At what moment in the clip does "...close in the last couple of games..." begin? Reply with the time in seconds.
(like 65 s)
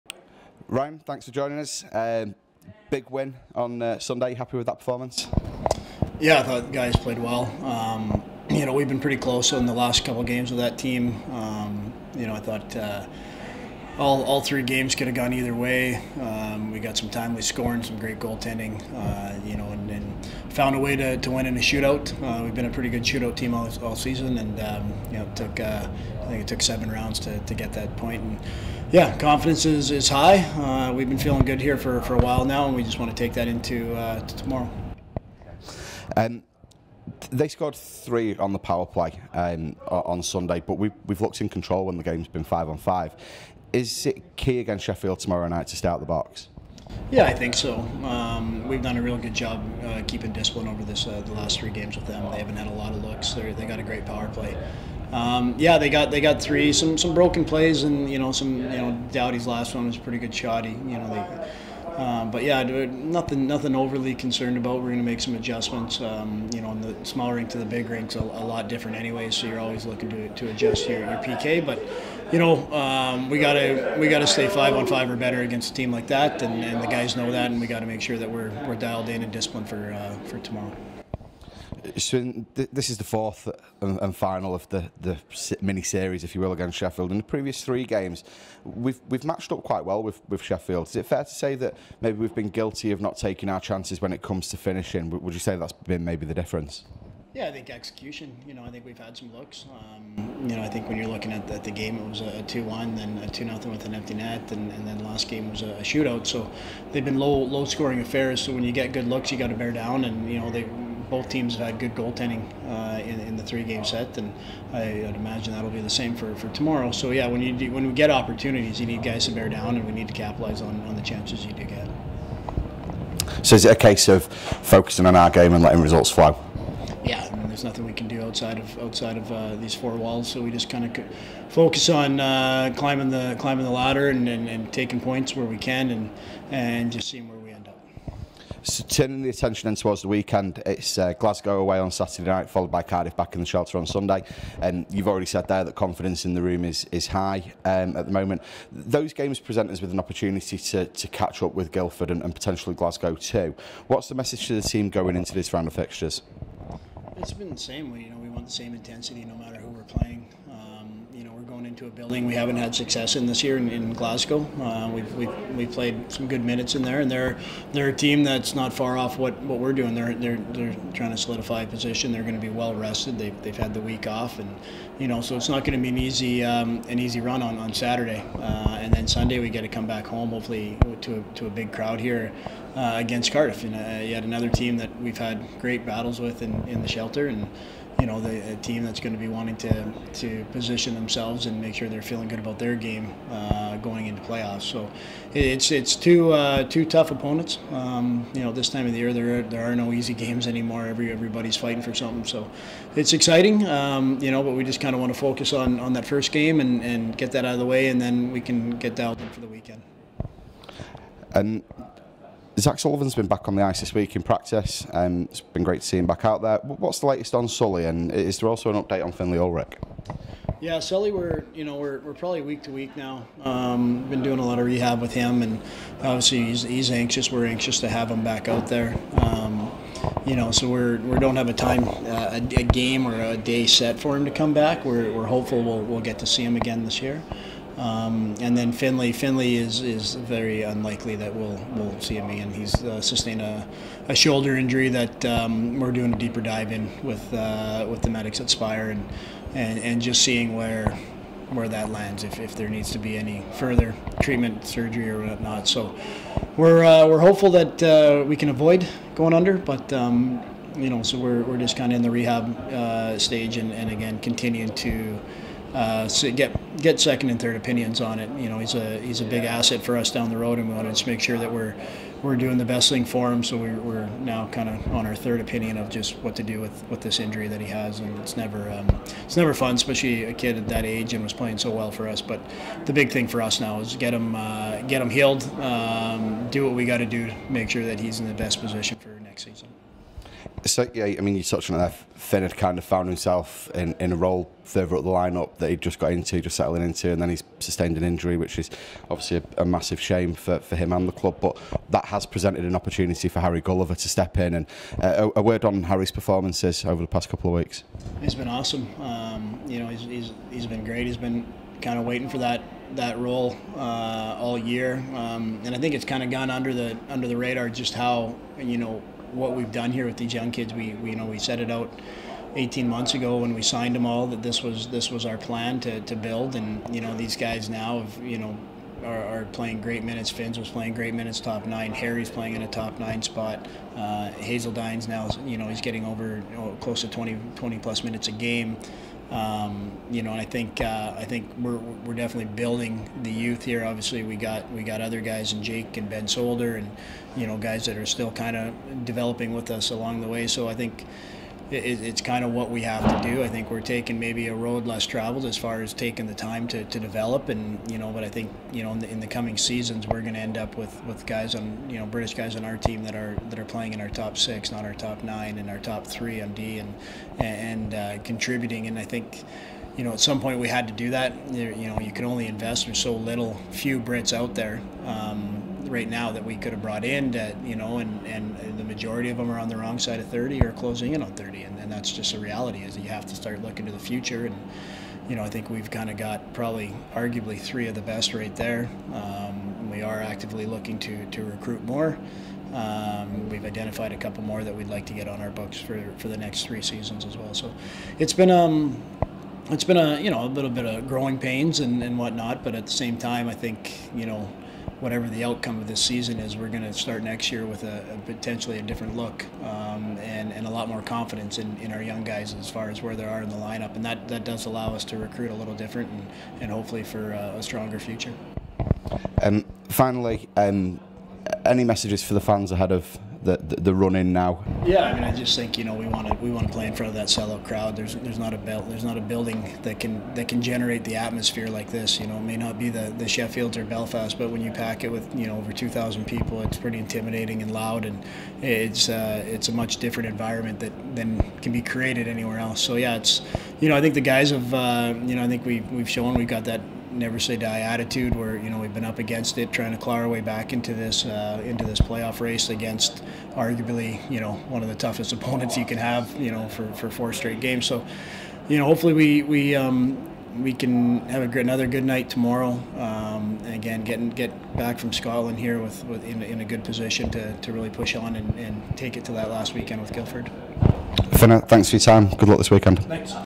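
9 s.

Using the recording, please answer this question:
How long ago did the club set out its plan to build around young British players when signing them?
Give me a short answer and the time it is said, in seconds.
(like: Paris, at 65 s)
18 months, at 322 s.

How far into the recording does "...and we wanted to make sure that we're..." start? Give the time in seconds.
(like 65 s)
270 s.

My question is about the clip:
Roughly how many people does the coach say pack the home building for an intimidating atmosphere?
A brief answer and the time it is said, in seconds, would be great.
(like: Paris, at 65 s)
over 2,000, at 435 s.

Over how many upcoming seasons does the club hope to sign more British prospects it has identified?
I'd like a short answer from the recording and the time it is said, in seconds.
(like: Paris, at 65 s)
3 seasons, at 396 s.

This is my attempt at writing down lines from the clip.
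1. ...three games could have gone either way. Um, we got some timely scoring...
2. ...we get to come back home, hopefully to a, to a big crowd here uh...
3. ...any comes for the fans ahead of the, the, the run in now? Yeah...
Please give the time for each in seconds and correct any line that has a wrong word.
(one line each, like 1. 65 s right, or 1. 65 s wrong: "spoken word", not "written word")
1. 14 s right
2. 179 s right
3. 421 s wrong: "messages", not "comes".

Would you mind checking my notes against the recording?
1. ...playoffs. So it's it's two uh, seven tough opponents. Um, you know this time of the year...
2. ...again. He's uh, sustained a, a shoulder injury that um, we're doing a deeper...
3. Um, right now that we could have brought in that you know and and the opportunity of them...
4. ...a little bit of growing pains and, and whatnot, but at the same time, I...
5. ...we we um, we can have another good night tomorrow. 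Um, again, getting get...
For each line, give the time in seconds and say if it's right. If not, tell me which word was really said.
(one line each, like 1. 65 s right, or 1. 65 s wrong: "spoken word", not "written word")
1. 194 s wrong: "two", not "seven"
2. 242 s right
3. 375 s wrong: "majority", not "opportunity"
4. 400 s right
5. 459 s right.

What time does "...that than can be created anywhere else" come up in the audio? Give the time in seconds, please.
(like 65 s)
440 s.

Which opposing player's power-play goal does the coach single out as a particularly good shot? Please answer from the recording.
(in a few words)
Dowdy.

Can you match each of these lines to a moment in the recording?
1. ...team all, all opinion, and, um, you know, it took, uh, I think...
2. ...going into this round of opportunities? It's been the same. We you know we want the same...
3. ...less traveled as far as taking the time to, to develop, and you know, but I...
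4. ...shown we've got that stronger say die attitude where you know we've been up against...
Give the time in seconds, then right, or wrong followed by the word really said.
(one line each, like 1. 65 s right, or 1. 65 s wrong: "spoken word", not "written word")
1. 23 s wrong: "season", not "opinion"
2. 154 s wrong: "fixtures", not "opportunities"
3. 354 s right
4. 446 s wrong: "never", not "stronger".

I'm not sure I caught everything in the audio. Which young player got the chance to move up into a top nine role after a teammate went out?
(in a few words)
Harry Gulliver.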